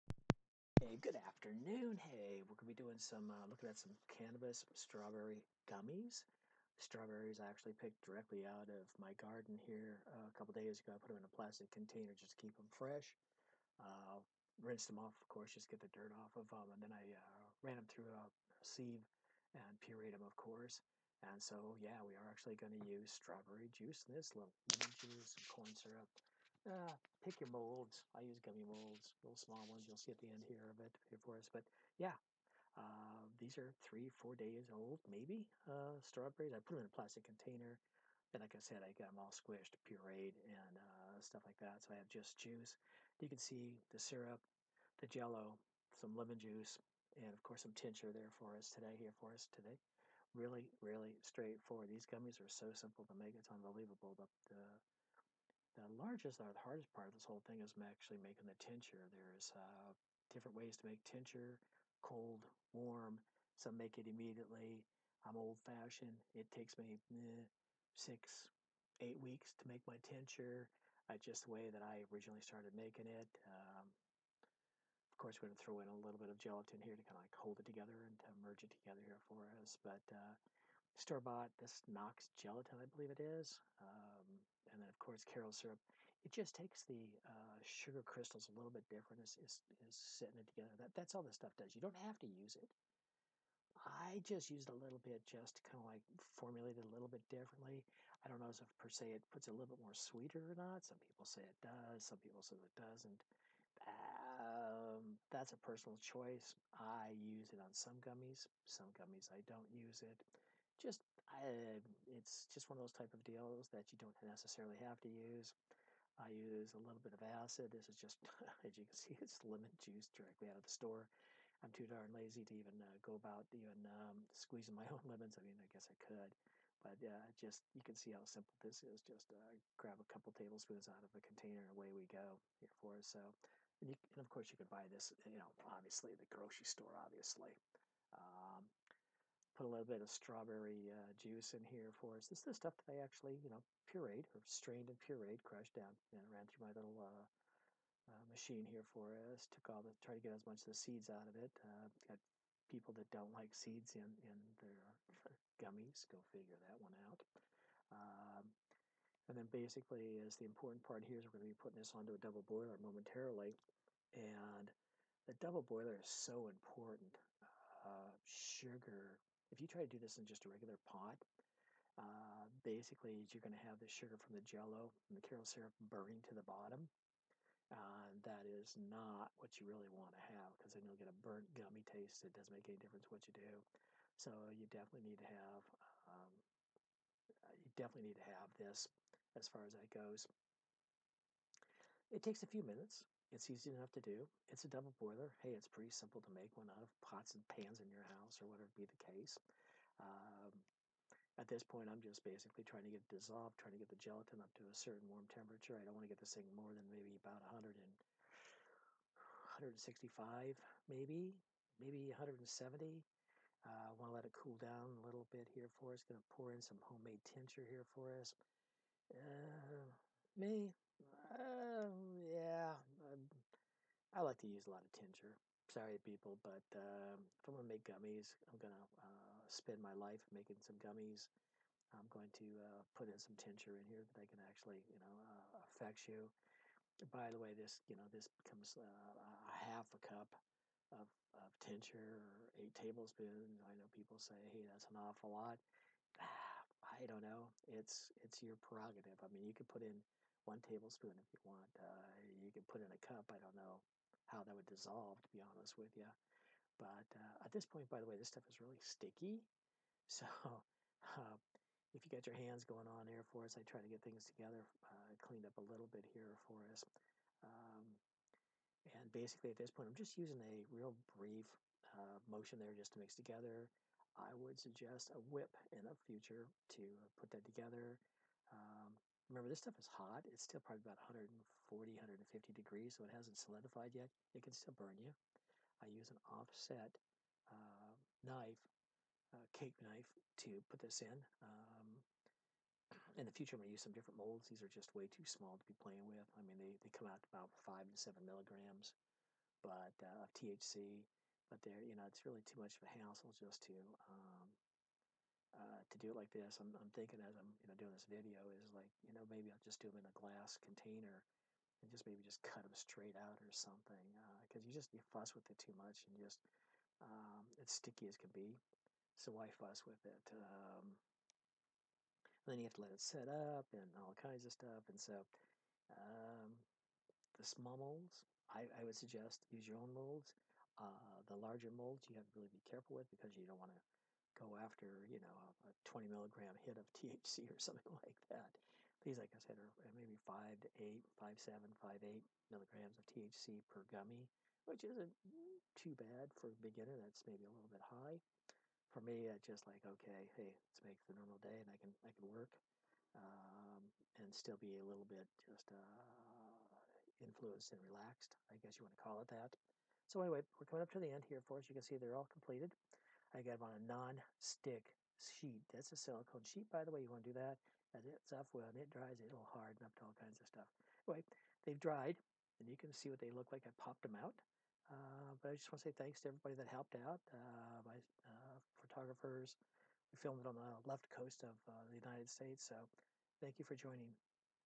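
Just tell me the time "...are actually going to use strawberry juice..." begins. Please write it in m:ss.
0:22.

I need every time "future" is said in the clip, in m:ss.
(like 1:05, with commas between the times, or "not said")
4:36, 4:53.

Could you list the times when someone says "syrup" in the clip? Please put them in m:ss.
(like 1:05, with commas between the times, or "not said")
0:25, 0:43, 1:25, 2:55.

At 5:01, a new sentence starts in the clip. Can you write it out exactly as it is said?
But they're, you know, it's really too much of a hassle just to um, uh, to do it like this.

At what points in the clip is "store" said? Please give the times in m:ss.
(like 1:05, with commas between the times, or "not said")
1:20, 2:00, 2:16.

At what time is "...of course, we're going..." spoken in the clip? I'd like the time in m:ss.
1:13.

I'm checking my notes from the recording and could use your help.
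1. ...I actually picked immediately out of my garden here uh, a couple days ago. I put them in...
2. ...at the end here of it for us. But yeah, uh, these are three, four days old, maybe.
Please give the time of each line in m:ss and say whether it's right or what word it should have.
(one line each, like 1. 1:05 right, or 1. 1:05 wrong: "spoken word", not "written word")
1. 0:07 wrong: "directly", not "immediately"
2. 0:30 right.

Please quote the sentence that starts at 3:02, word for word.
It doesn't make any difference what you do.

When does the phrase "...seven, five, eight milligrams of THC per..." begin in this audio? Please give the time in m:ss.
5:41.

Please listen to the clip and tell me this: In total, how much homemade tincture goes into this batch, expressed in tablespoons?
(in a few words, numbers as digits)
8 tablespoons.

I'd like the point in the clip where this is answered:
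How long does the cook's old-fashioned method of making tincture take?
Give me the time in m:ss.
1:07.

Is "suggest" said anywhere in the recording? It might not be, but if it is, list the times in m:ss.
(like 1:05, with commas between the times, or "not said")
4:34, 5:28.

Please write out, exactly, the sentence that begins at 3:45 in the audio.
Sorry, people, but uh, if I'm gonna make gummies, I'm gonna uh, spend my life making some gummies.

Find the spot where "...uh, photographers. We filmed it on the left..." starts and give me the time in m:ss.
6:18.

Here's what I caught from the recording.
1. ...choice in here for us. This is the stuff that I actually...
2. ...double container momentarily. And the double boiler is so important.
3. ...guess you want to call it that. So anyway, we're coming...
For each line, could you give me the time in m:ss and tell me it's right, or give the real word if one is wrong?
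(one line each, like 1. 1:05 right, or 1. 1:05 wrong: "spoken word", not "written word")
1. 2:21 wrong: "juice", not "choice"
2. 2:42 wrong: "boiler", not "container"
3. 5:58 right.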